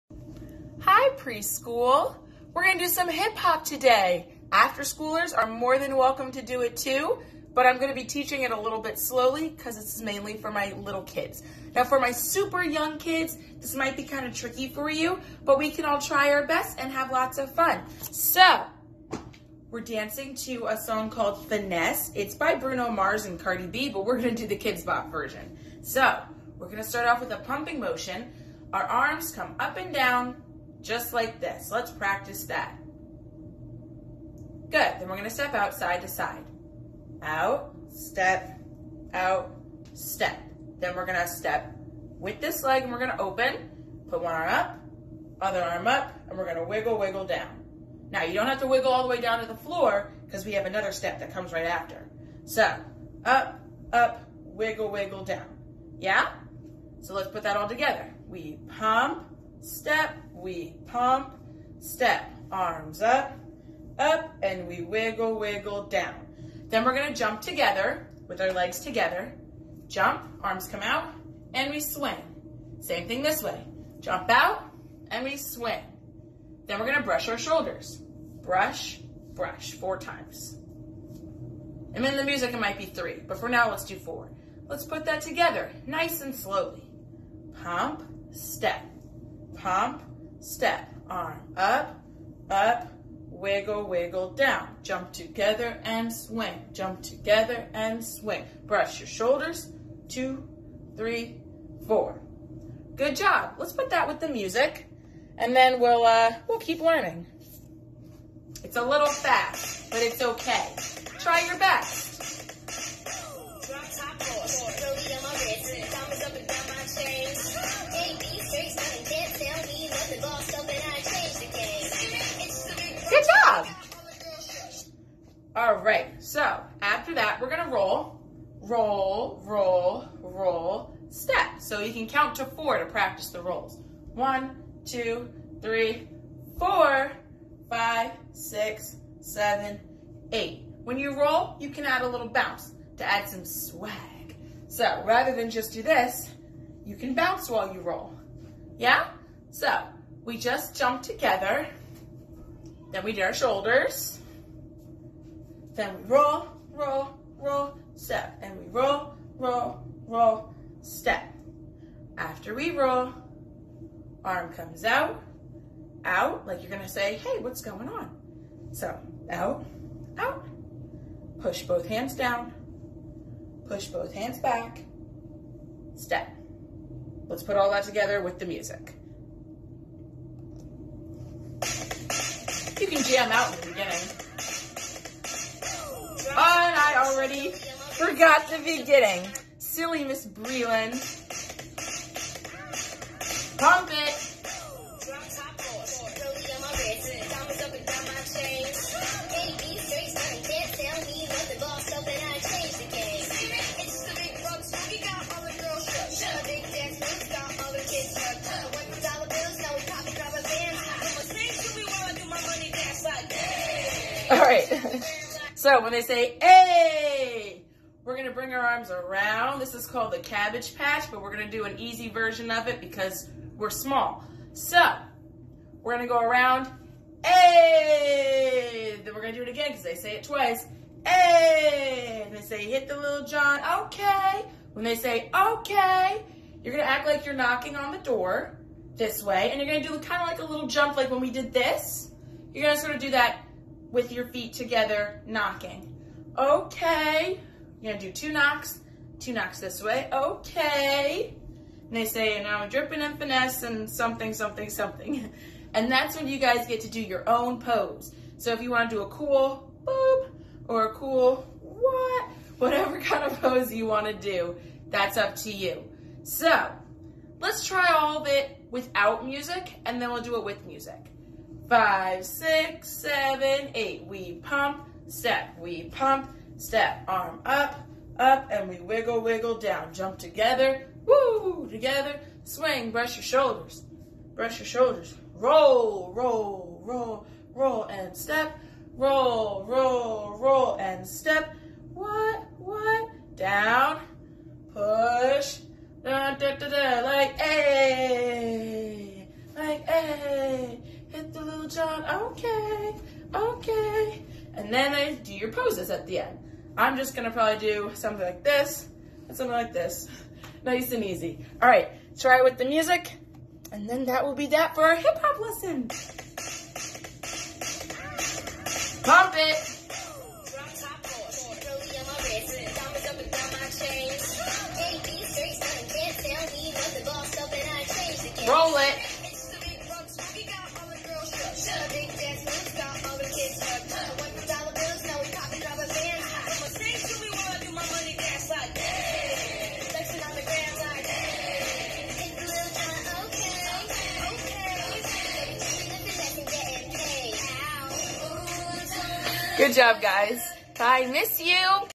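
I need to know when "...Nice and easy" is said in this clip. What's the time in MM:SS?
05:10.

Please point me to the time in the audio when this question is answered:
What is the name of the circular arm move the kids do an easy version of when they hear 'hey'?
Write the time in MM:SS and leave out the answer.
03:40.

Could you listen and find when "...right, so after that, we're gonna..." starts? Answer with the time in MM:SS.
02:05.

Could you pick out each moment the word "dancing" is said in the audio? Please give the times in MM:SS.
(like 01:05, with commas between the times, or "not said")
00:19.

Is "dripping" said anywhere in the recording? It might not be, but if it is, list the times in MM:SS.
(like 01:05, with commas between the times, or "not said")
04:12.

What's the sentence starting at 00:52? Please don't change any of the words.
So up, up, wiggle, wiggle down.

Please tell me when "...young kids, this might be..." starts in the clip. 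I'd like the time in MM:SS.
00:12.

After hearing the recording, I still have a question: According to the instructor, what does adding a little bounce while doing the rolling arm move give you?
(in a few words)
swag.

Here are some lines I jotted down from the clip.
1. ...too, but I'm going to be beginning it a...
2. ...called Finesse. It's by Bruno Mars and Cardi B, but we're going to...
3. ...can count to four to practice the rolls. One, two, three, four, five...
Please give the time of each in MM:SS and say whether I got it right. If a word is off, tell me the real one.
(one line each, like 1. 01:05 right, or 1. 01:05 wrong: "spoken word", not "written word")
1. 00:06 wrong: "teaching", not "beginning"
2. 00:21 right
3. 02:11 right.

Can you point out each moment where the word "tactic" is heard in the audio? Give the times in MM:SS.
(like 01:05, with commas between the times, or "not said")
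not said.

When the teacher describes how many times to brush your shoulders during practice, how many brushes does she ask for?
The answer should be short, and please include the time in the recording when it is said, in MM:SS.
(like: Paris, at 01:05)
4 times, at 01:19.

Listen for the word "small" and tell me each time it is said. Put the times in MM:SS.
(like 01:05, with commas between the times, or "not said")
03:43.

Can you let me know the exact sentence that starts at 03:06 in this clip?
But I already forgot the beginning.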